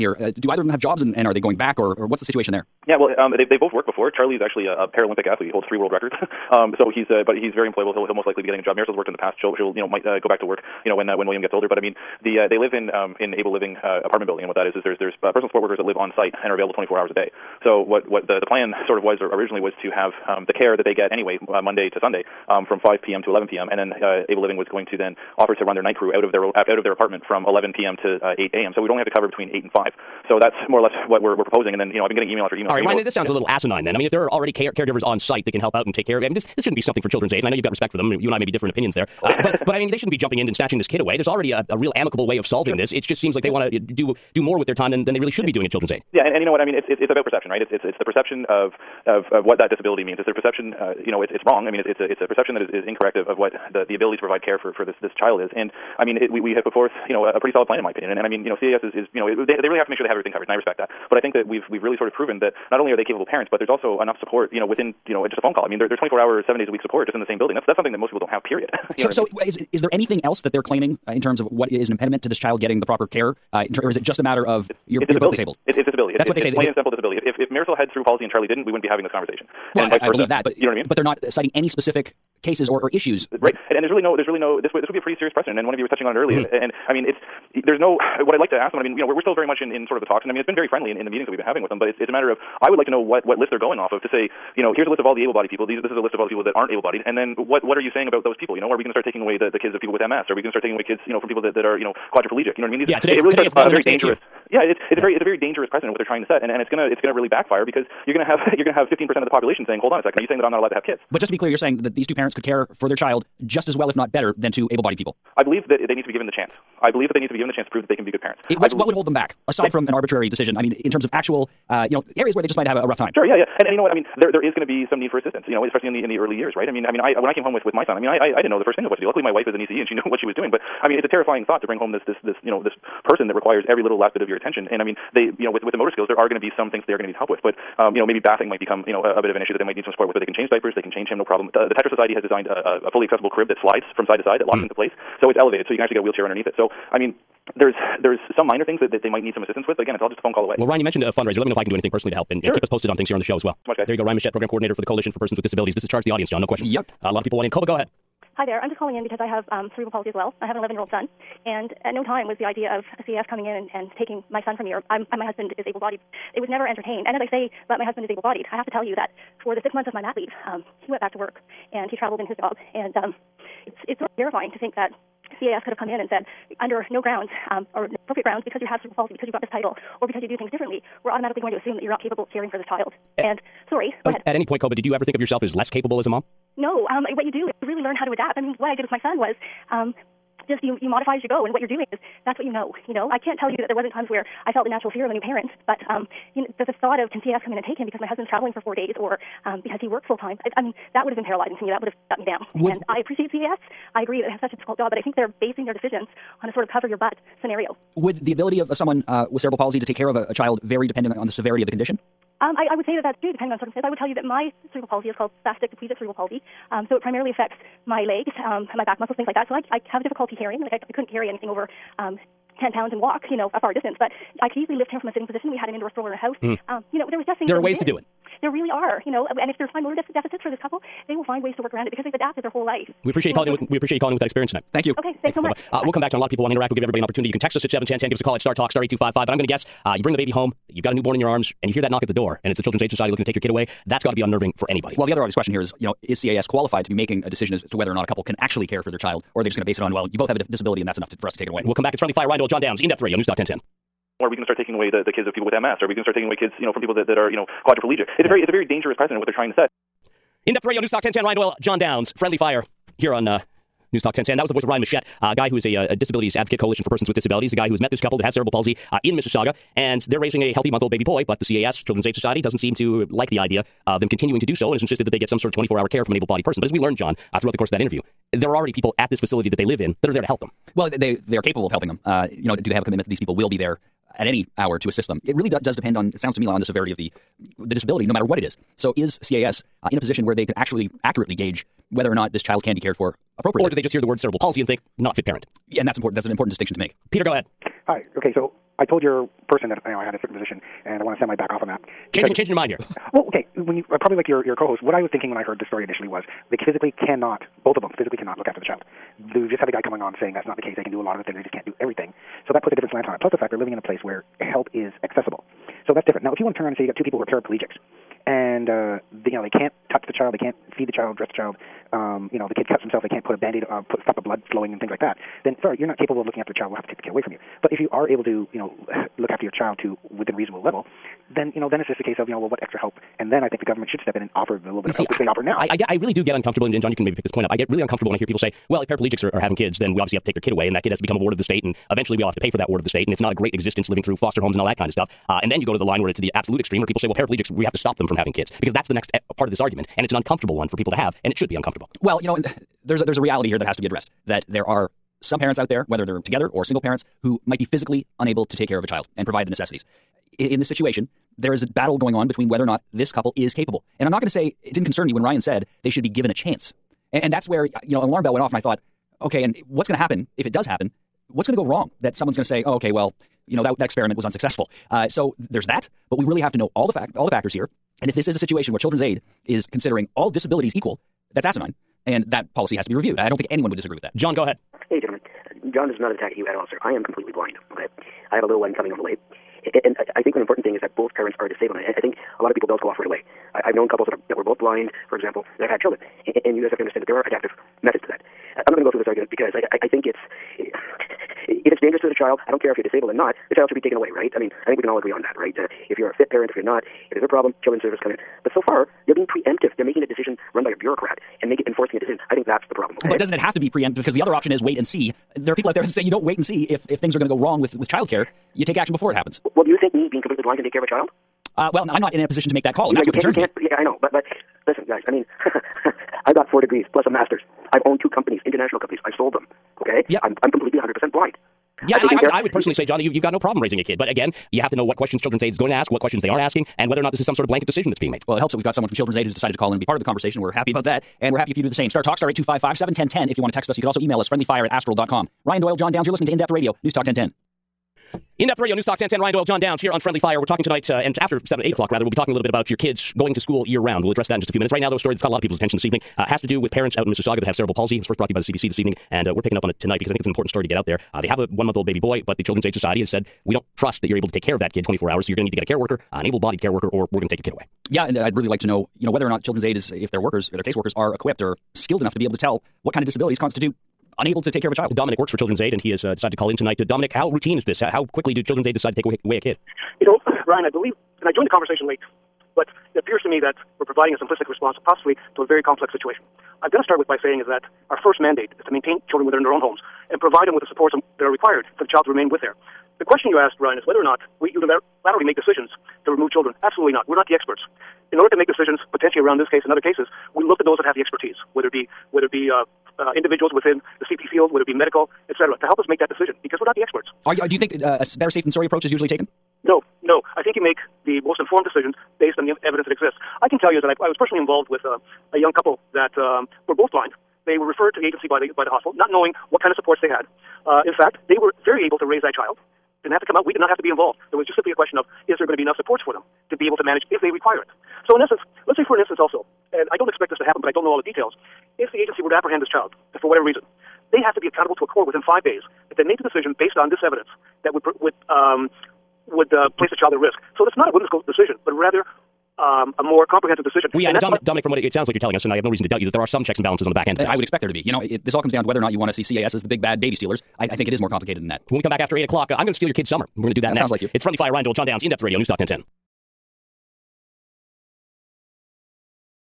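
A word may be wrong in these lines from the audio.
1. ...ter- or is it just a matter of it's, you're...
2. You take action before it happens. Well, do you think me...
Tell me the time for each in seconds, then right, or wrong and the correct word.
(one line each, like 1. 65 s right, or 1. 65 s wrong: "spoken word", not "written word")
1. 73 s right
2. 418 s right.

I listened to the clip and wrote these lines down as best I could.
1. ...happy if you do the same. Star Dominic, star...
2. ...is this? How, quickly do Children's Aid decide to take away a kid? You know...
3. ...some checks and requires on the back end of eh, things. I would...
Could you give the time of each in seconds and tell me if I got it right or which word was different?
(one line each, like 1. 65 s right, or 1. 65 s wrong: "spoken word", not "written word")
1. 441 s wrong: "Talk", not "Dominic"
2. 477 s right
3. 546 s wrong: "balances", not "requires".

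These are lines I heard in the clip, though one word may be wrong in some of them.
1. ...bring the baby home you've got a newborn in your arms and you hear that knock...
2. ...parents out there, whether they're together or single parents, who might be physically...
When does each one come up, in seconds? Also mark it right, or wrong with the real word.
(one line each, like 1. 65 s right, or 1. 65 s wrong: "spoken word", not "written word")
1. 240 s right
2. 355 s right.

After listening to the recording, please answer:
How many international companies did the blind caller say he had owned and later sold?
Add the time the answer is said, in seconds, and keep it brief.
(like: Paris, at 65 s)
2, at 428 s.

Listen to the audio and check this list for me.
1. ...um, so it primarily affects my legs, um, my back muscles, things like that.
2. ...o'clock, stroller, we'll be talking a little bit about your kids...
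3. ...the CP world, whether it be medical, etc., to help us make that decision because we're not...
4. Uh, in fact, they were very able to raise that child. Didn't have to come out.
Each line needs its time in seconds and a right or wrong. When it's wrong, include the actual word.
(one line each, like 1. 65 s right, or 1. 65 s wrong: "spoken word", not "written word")
1. 216 s right
2. 451 s wrong: "rather", not "stroller"
3. 504 s wrong: "field", not "world"
4. 520 s right.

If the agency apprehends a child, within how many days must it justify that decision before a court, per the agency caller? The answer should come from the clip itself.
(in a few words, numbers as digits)
5 days.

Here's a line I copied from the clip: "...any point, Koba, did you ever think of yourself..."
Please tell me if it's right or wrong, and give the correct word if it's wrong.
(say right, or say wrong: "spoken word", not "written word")
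right.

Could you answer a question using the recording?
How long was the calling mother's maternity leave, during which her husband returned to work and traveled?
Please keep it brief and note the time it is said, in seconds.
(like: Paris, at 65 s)
6 months, at 169 s.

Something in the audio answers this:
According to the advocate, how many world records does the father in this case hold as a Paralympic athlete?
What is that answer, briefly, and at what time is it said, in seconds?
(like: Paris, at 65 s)
3, at 5 s.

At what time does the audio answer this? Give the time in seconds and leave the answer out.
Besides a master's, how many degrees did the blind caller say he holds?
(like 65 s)
426 s.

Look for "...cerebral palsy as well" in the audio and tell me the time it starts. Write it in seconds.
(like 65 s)
159 s.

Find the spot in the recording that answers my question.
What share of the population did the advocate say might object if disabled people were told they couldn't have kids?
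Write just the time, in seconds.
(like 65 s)
108 s.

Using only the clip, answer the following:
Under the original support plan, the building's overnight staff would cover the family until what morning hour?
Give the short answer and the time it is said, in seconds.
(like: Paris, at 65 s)
8 a.m., at 28 s.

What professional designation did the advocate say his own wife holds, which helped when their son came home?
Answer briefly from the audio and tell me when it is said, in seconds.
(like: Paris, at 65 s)
ECE, at 129 s.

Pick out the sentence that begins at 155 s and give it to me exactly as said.
This is Charge the Audience, John.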